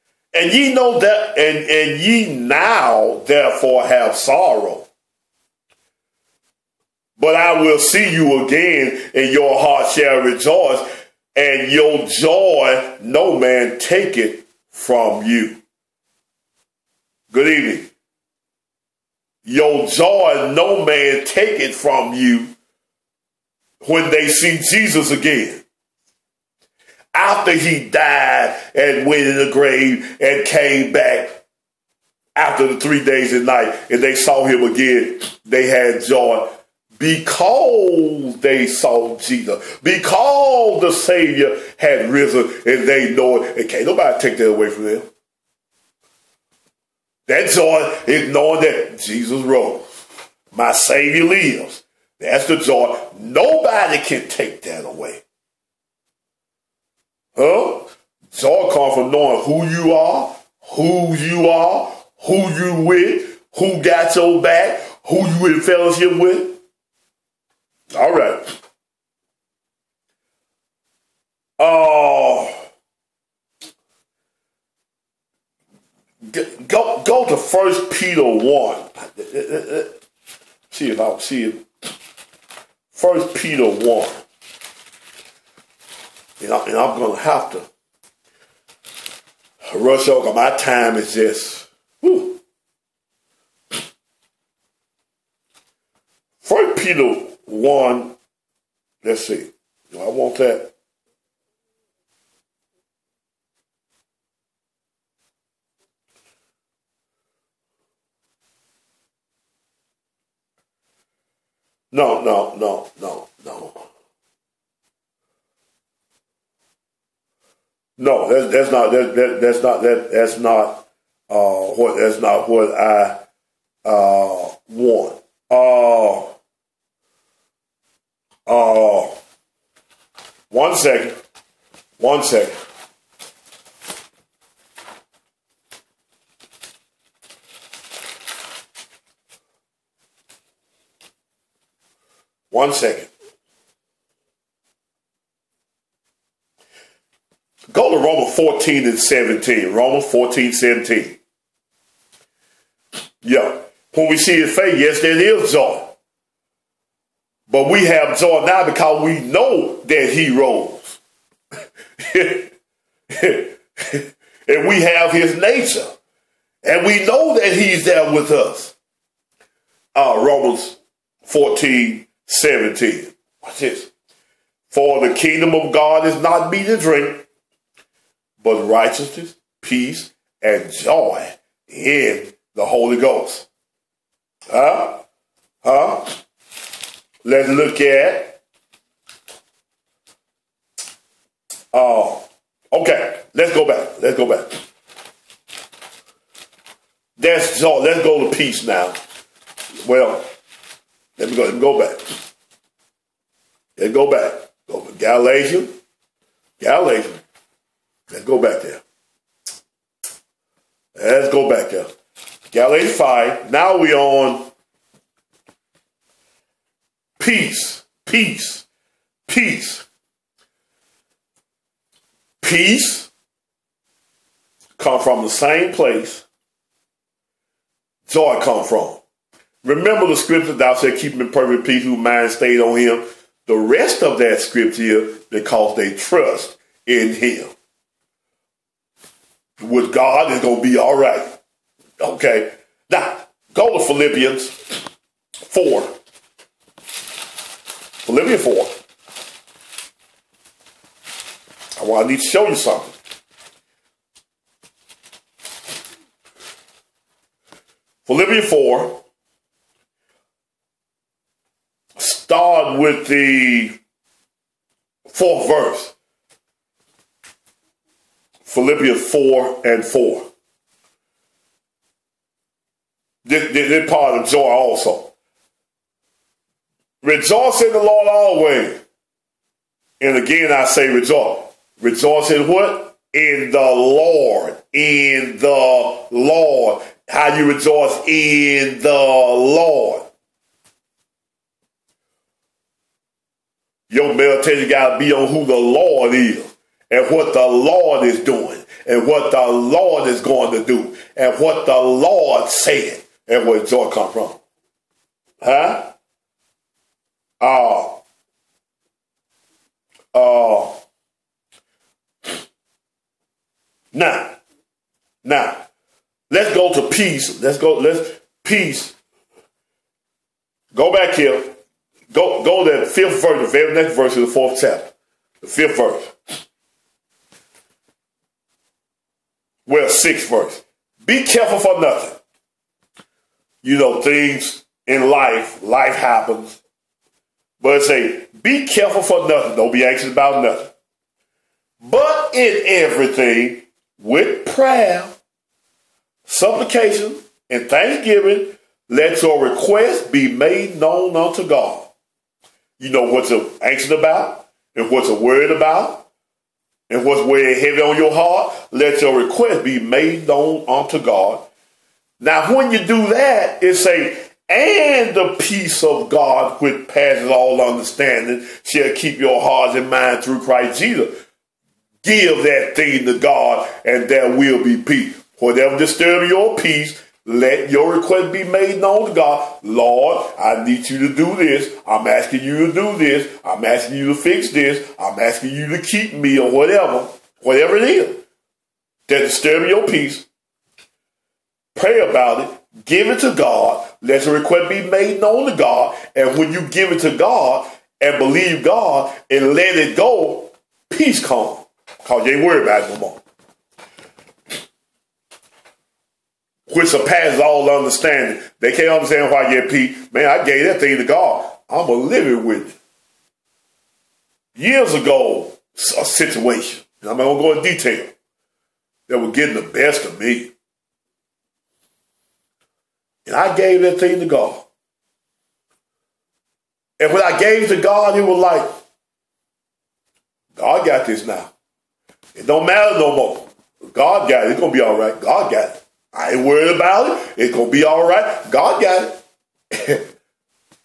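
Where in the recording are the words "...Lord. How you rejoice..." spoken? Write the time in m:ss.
4:46.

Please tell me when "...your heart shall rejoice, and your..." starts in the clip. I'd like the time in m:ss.
0:09.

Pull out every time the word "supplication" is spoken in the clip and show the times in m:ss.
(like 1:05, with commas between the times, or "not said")
5:46.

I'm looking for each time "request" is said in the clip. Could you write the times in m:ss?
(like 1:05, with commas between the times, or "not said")
5:49, 5:59, 6:17, 6:34.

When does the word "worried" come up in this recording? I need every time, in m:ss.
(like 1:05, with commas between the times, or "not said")
5:55, 6:42, 7:16.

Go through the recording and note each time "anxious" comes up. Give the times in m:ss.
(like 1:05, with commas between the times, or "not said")
5:39, 5:53.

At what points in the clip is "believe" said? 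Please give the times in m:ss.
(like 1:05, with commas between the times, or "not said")
6:38.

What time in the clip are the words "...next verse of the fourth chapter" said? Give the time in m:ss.
5:23.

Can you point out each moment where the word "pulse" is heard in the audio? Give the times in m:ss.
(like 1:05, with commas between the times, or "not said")
not said.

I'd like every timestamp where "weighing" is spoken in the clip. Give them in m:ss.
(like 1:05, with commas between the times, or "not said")
5:57.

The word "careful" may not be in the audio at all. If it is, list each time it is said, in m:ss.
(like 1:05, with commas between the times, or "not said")
5:31, 5:38.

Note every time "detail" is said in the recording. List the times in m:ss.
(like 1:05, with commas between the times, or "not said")
6:57.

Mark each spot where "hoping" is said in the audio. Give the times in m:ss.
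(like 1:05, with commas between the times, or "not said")
not said.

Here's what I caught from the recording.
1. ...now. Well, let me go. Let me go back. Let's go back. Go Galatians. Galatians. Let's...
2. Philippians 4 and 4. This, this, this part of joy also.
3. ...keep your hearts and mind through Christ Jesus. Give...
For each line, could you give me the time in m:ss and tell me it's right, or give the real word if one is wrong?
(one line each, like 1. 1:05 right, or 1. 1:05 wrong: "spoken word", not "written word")
1. 3:18 right
2. 4:28 right
3. 6:08 right.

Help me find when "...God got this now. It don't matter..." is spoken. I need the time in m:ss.
7:10.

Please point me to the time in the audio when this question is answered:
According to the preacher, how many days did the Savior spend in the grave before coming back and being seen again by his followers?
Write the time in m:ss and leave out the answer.
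0:32.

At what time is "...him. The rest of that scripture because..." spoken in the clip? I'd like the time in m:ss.
3:52.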